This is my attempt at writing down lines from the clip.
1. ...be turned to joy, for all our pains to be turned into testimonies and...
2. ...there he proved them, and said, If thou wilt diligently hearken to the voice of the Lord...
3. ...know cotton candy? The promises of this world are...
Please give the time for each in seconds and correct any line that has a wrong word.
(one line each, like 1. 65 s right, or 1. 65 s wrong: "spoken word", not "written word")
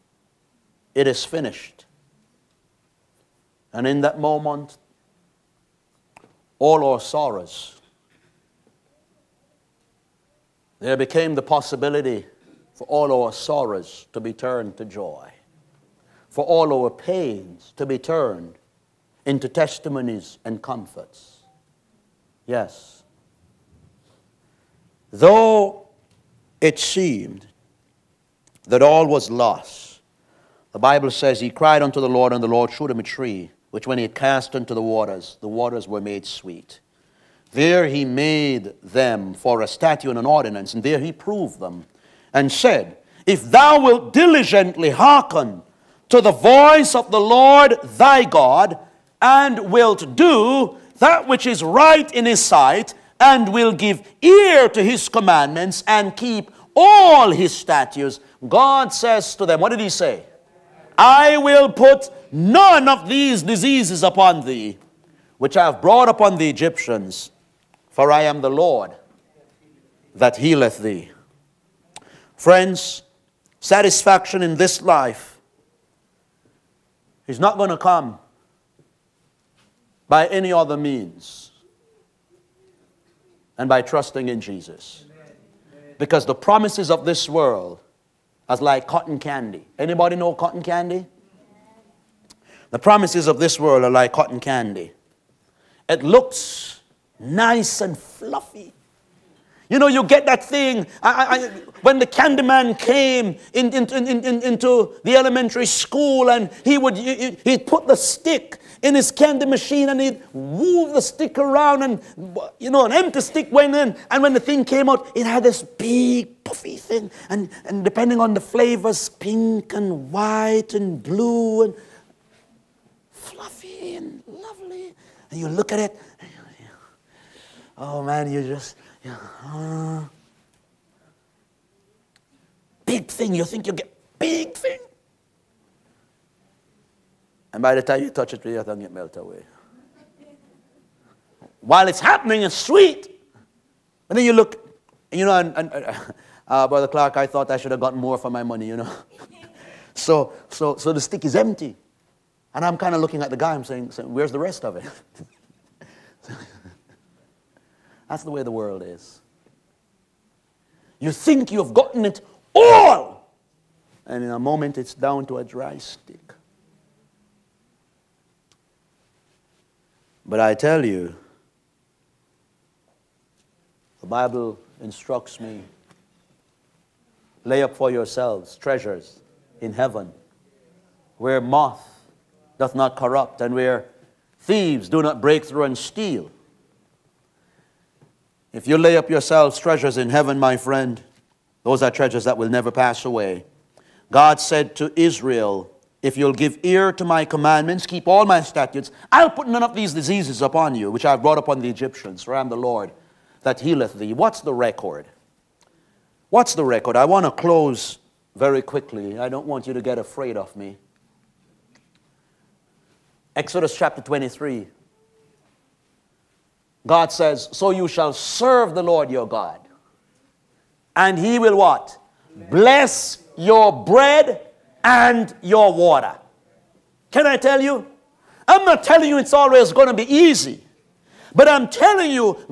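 1. 14 s right
2. 40 s right
3. 90 s right.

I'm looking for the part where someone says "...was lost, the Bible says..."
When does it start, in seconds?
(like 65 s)
29 s.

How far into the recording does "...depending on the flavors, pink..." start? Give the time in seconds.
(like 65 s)
117 s.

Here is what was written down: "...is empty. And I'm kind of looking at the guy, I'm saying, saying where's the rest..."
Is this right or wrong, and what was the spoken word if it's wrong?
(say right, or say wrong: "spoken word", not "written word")
right.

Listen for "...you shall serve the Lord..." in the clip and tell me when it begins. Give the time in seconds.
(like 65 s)
217 s.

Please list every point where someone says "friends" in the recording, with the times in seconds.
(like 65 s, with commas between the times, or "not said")
72 s, 190 s.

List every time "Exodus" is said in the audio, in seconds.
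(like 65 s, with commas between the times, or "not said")
213 s.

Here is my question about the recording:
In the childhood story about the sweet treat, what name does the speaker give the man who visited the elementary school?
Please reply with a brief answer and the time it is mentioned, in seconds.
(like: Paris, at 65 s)
The Candyman, at 102 s.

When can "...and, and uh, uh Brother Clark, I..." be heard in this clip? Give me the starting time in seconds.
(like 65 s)
145 s.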